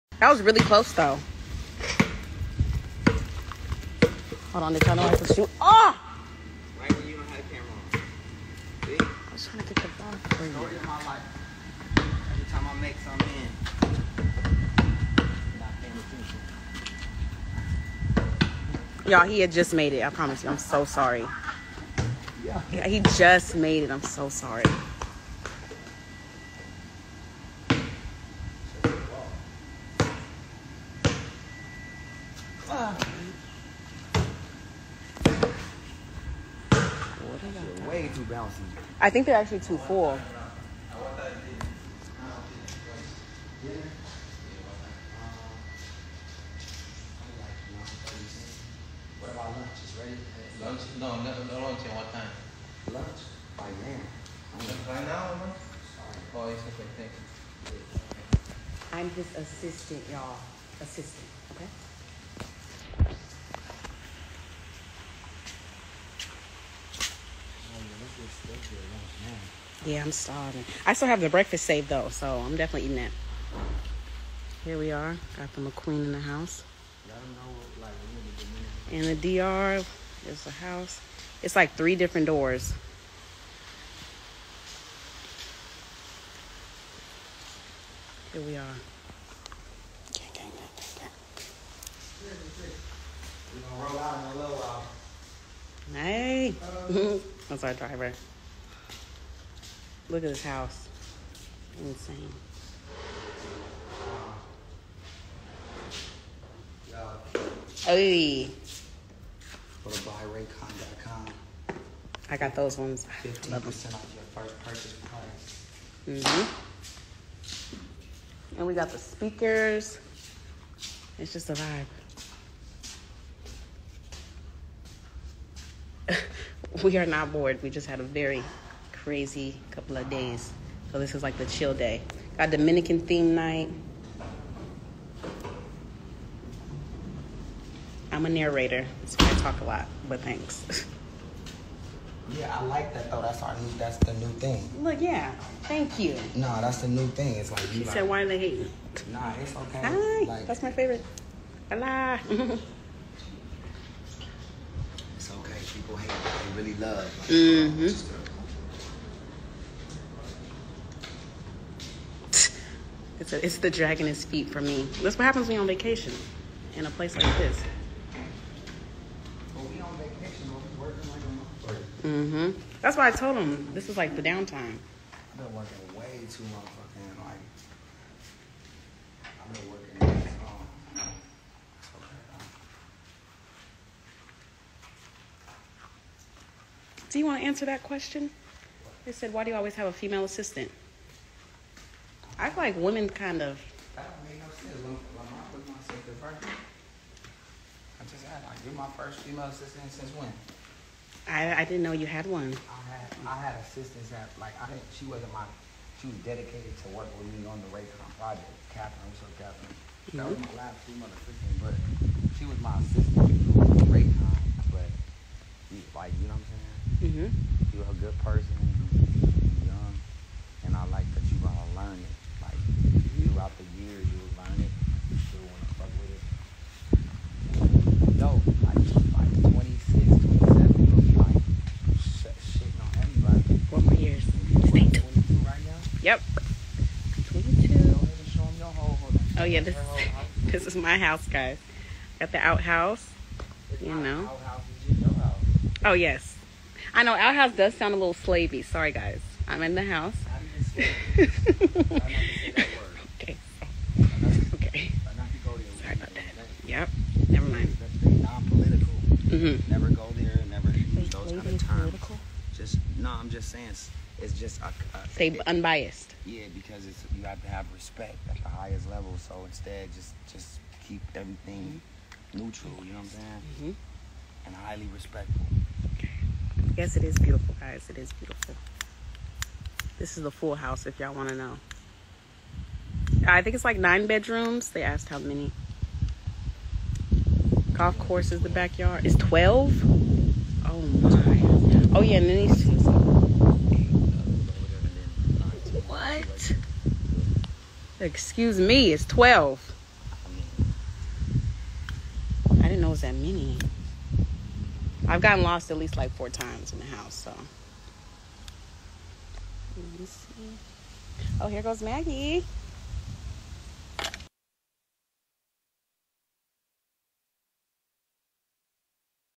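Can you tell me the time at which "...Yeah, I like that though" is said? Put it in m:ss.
2:22.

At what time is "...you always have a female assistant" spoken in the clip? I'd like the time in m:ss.
3:09.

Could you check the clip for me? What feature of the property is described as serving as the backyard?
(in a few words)
Golf course.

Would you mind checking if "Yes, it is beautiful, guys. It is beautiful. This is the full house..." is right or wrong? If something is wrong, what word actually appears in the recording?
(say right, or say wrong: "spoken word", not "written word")
right.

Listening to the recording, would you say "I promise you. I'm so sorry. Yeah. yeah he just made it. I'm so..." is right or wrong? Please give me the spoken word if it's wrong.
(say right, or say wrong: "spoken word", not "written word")
right.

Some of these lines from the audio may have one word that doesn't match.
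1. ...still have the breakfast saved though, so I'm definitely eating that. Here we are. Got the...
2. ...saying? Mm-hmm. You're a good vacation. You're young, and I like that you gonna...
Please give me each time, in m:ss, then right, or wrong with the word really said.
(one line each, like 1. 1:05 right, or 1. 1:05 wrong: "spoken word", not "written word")
1. 1:10 right
2. 3:36 wrong: "person", not "vacation".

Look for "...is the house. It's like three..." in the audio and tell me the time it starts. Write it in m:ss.
1:20.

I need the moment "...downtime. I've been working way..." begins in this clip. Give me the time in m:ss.
2:54.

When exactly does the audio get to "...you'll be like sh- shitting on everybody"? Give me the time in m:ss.
3:50.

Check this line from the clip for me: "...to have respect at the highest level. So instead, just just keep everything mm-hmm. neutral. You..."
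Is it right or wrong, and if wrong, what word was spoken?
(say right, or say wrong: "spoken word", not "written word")
right.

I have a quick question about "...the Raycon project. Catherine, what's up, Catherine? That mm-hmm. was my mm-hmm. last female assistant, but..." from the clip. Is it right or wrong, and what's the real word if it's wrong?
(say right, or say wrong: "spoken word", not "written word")
right.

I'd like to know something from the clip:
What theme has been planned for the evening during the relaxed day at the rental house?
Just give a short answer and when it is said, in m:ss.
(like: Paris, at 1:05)
Dominican theme night, at 2:12.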